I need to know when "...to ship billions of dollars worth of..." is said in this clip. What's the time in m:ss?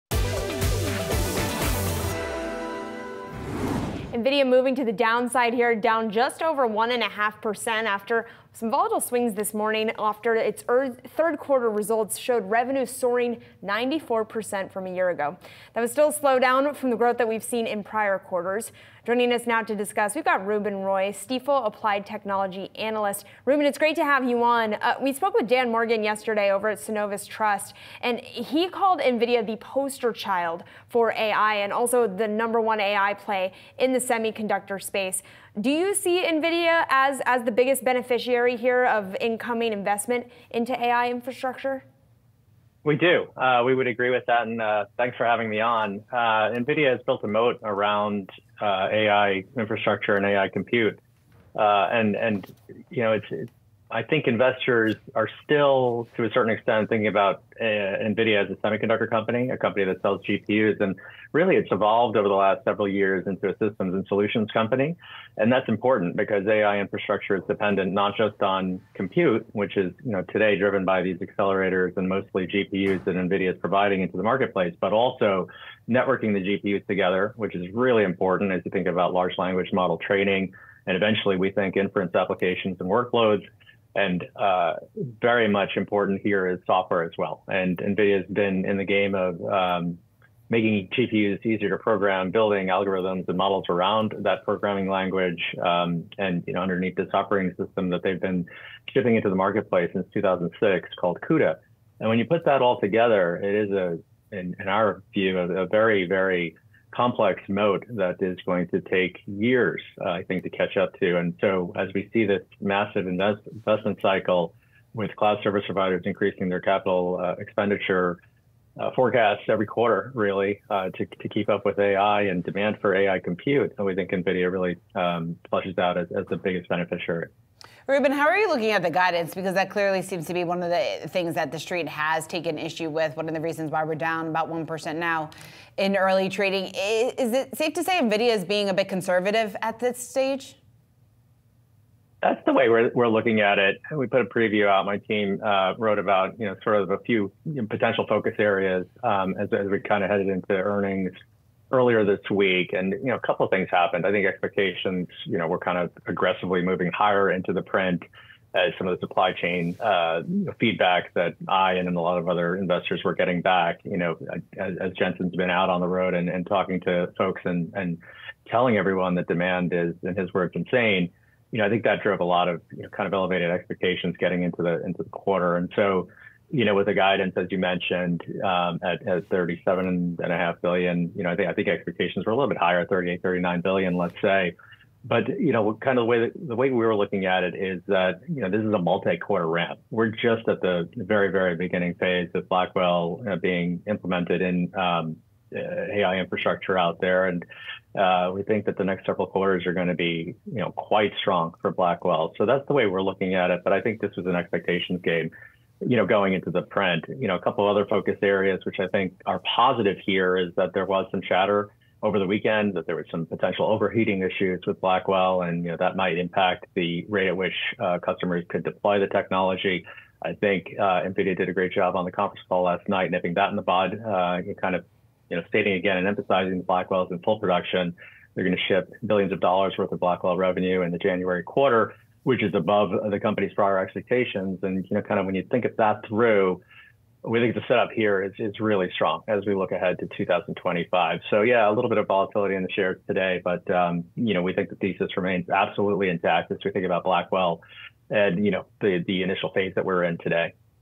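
3:48.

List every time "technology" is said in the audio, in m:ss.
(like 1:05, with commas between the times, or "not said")
0:22, 3:39.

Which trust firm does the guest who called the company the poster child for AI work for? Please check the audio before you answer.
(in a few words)
Synovus Trust.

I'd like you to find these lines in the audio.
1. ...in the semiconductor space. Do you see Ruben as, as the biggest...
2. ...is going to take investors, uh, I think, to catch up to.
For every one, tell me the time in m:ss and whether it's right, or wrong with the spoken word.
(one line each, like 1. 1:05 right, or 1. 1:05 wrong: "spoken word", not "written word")
1. 0:33 wrong: "NVIDIA", not "Ruben"
2. 1:48 wrong: "years", not "investors".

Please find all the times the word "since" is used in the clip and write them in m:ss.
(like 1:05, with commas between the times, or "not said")
1:39.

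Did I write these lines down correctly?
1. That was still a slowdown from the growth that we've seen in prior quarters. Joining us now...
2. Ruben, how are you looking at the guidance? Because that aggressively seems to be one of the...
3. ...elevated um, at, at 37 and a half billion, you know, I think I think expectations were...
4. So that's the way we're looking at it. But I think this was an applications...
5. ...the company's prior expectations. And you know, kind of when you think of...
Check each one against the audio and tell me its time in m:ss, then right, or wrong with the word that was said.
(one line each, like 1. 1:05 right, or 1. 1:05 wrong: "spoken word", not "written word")
1. 0:15 right
2. 2:07 wrong: "clearly", not "aggressively"
3. 2:57 wrong: "mentioned", not "elevated"
4. 3:22 wrong: "expectations", not "applications"
5. 3:53 right.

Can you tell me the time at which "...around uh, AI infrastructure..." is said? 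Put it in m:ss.
0:47.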